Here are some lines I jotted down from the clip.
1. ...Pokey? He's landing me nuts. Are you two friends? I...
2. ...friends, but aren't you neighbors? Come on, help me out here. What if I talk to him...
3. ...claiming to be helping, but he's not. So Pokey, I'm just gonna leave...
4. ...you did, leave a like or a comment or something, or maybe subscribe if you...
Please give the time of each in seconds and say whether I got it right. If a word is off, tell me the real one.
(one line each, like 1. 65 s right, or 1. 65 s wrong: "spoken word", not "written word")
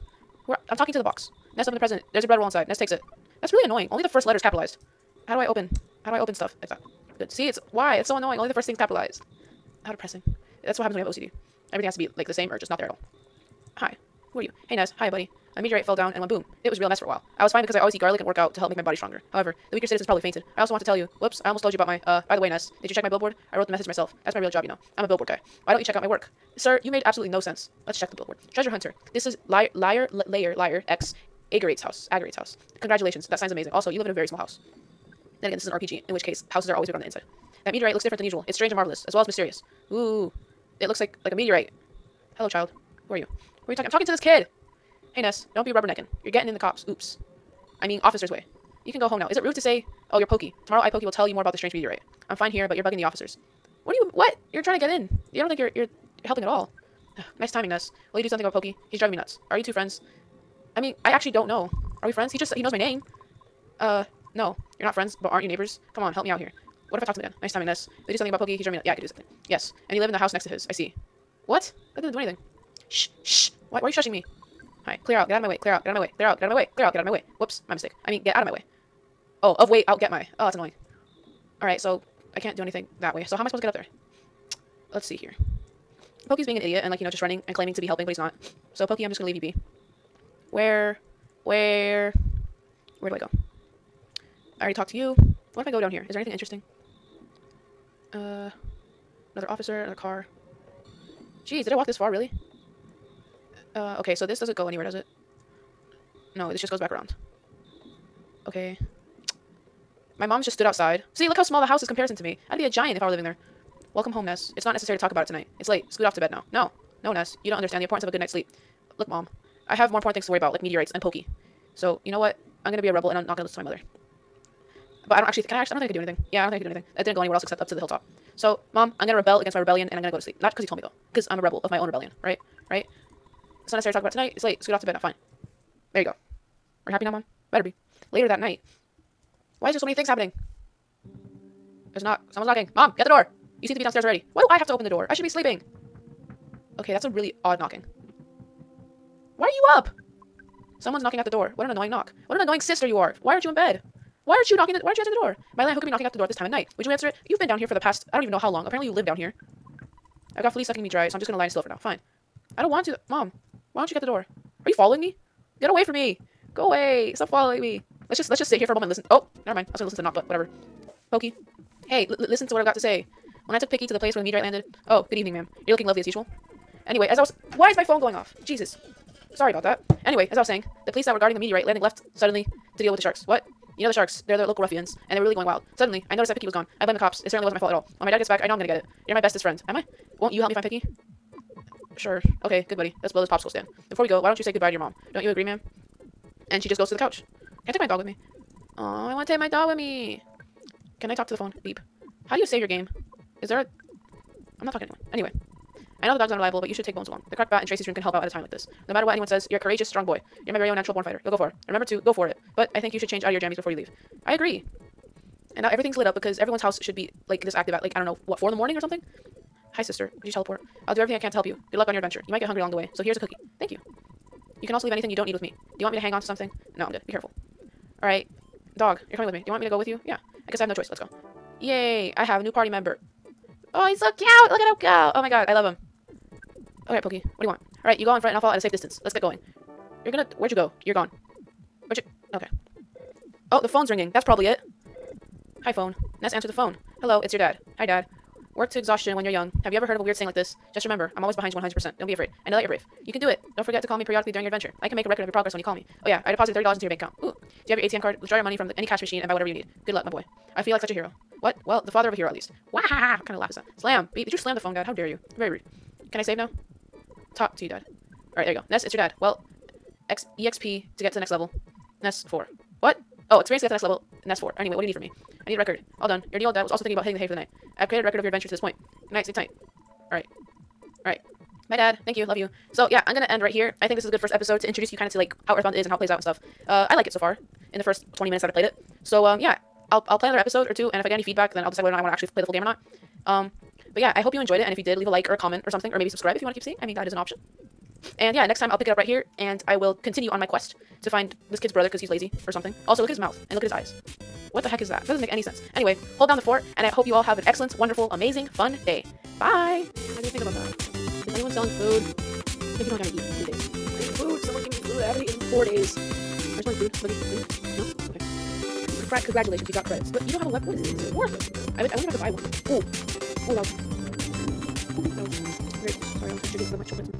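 1. 58 s wrong: "driving", not "landing"
2. 64 s right
3. 87 s right
4. 294 s right.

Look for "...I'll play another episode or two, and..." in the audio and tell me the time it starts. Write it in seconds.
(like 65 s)
290 s.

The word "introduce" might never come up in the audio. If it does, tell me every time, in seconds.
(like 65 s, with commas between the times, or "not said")
284 s.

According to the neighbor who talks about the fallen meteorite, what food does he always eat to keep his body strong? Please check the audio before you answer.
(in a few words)
Garlic.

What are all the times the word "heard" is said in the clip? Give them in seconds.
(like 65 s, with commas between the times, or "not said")
249 s.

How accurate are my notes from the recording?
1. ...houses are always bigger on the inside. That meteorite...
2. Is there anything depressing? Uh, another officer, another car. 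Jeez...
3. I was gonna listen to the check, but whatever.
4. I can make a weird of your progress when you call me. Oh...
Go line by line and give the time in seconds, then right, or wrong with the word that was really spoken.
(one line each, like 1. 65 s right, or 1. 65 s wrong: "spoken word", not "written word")
1. 36 s right
2. 96 s wrong: "interesting", not "depressing"
3. 169 s wrong: "knock", not "check"
4. 254 s wrong: "record", not "weird".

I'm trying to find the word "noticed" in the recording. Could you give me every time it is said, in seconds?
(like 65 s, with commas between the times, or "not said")
186 s.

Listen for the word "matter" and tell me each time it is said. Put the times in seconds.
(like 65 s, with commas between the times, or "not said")
208 s.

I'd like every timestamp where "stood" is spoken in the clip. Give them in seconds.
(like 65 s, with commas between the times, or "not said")
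110 s.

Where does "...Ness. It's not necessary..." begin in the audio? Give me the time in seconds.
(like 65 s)
114 s.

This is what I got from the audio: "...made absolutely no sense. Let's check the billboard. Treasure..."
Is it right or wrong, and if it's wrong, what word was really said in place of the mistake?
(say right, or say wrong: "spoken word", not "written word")
right.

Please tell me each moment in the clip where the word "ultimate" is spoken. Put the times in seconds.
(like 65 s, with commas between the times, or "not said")
not said.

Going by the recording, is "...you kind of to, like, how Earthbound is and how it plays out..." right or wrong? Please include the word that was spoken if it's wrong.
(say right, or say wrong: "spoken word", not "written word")
right.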